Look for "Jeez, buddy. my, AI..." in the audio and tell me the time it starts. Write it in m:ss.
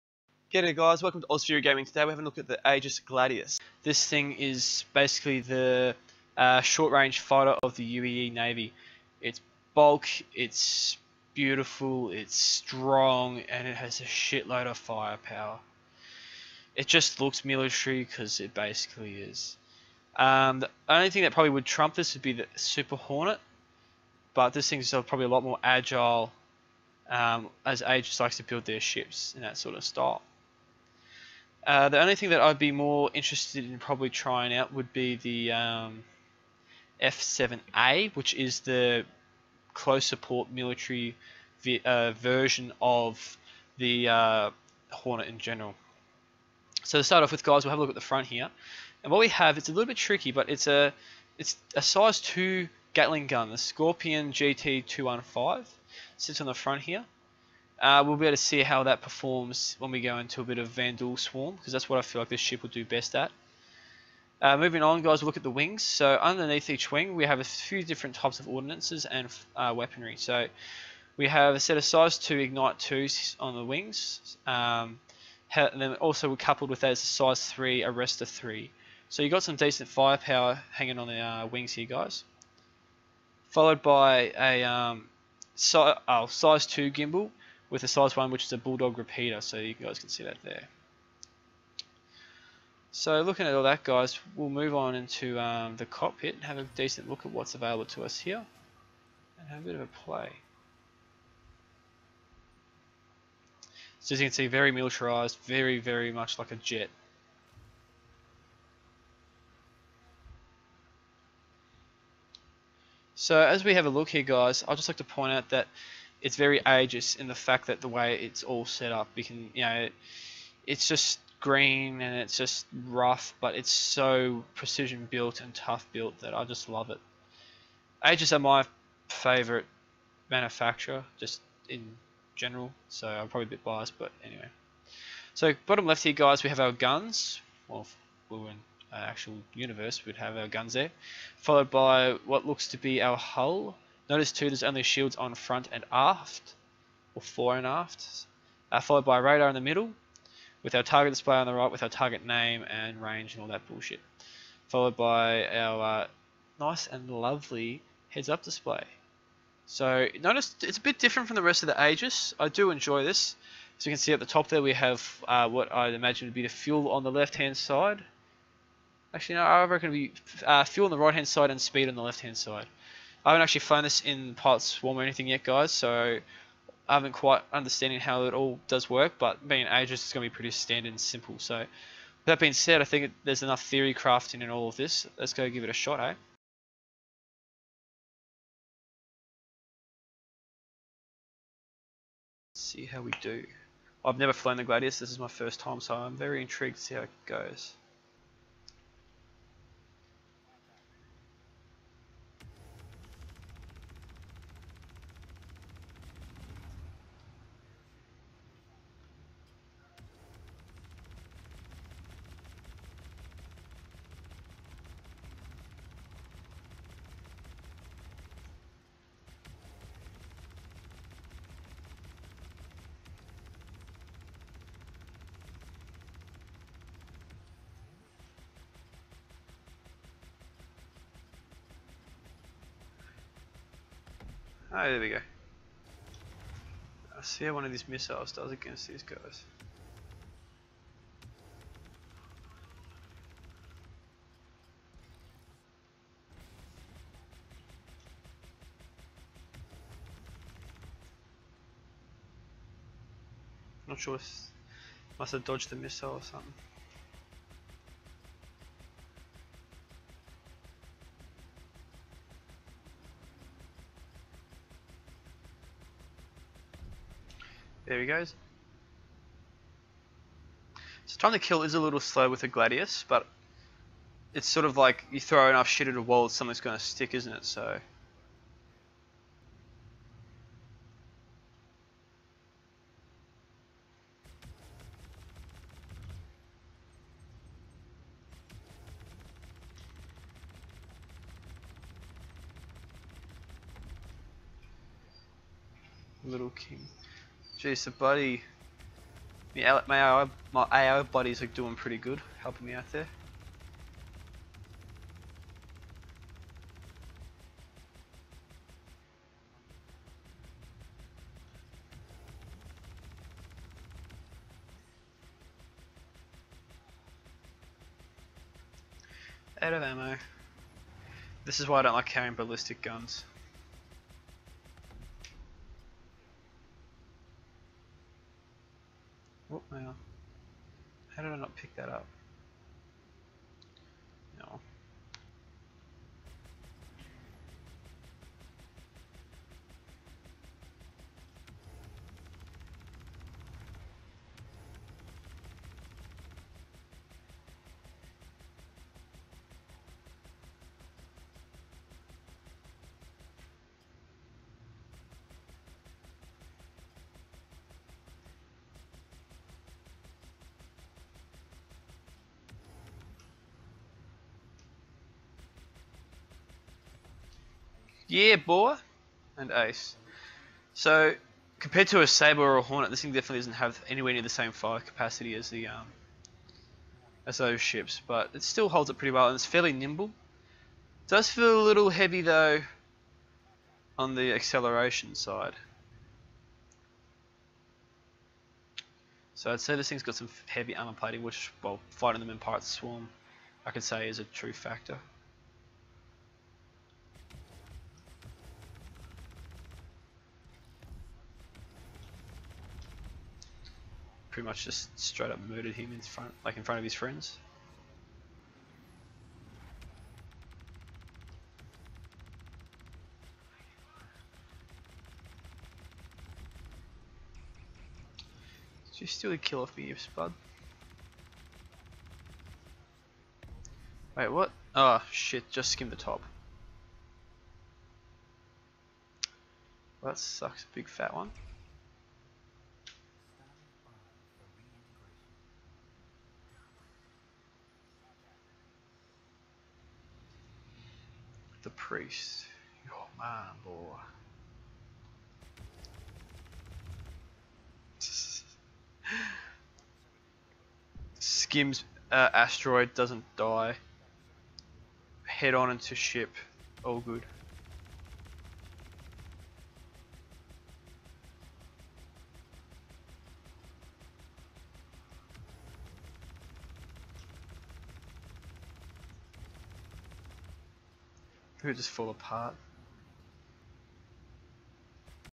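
4:57.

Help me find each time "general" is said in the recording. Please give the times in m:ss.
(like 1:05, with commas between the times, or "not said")
0:45, 2:12.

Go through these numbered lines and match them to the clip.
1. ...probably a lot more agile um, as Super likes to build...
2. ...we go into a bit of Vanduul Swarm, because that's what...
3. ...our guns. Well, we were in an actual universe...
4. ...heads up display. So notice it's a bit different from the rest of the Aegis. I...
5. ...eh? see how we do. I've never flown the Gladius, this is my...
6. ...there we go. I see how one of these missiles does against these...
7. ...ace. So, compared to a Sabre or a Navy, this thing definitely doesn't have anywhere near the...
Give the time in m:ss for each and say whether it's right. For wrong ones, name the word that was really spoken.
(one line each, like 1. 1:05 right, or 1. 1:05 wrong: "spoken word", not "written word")
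1. 0:24 wrong: "Aegis", not "Super"
2. 0:59 right
3. 2:16 right
4. 2:38 right
5. 3:05 right
6. 3:54 right
7. 6:09 wrong: "Hornet", not "Navy".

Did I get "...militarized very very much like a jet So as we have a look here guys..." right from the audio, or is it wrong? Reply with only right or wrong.
right.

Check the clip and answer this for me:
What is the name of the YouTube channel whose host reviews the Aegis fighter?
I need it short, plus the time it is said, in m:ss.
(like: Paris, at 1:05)
Ozsphere Gaming, at 0:01.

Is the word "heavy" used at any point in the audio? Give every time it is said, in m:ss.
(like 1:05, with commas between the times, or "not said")
6:21, 6:30.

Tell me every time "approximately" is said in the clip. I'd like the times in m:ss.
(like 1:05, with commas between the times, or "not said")
not said.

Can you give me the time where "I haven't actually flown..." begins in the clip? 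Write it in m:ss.
2:53.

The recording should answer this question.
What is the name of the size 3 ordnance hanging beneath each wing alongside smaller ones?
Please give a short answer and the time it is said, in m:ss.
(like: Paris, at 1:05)
Arrester 3, at 1:17.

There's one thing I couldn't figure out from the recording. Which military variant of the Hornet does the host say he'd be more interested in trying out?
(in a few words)
F7A.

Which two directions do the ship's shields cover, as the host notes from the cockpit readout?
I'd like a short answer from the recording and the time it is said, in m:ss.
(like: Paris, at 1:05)
Fore and aft, at 2:27.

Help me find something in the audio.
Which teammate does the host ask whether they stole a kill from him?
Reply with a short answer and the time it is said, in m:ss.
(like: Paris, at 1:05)
Spud, at 6:59.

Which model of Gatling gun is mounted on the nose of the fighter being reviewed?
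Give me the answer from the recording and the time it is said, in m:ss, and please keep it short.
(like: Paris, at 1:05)
Scorpion GT215, at 0:53.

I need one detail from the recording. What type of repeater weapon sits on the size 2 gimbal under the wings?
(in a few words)
Bulldog.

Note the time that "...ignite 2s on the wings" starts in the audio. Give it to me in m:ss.
1:12.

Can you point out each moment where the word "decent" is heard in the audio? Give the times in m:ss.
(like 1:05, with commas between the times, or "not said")
1:19, 1:36.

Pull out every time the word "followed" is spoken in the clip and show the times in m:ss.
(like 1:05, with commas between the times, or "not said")
1:23, 2:21, 2:28, 2:34.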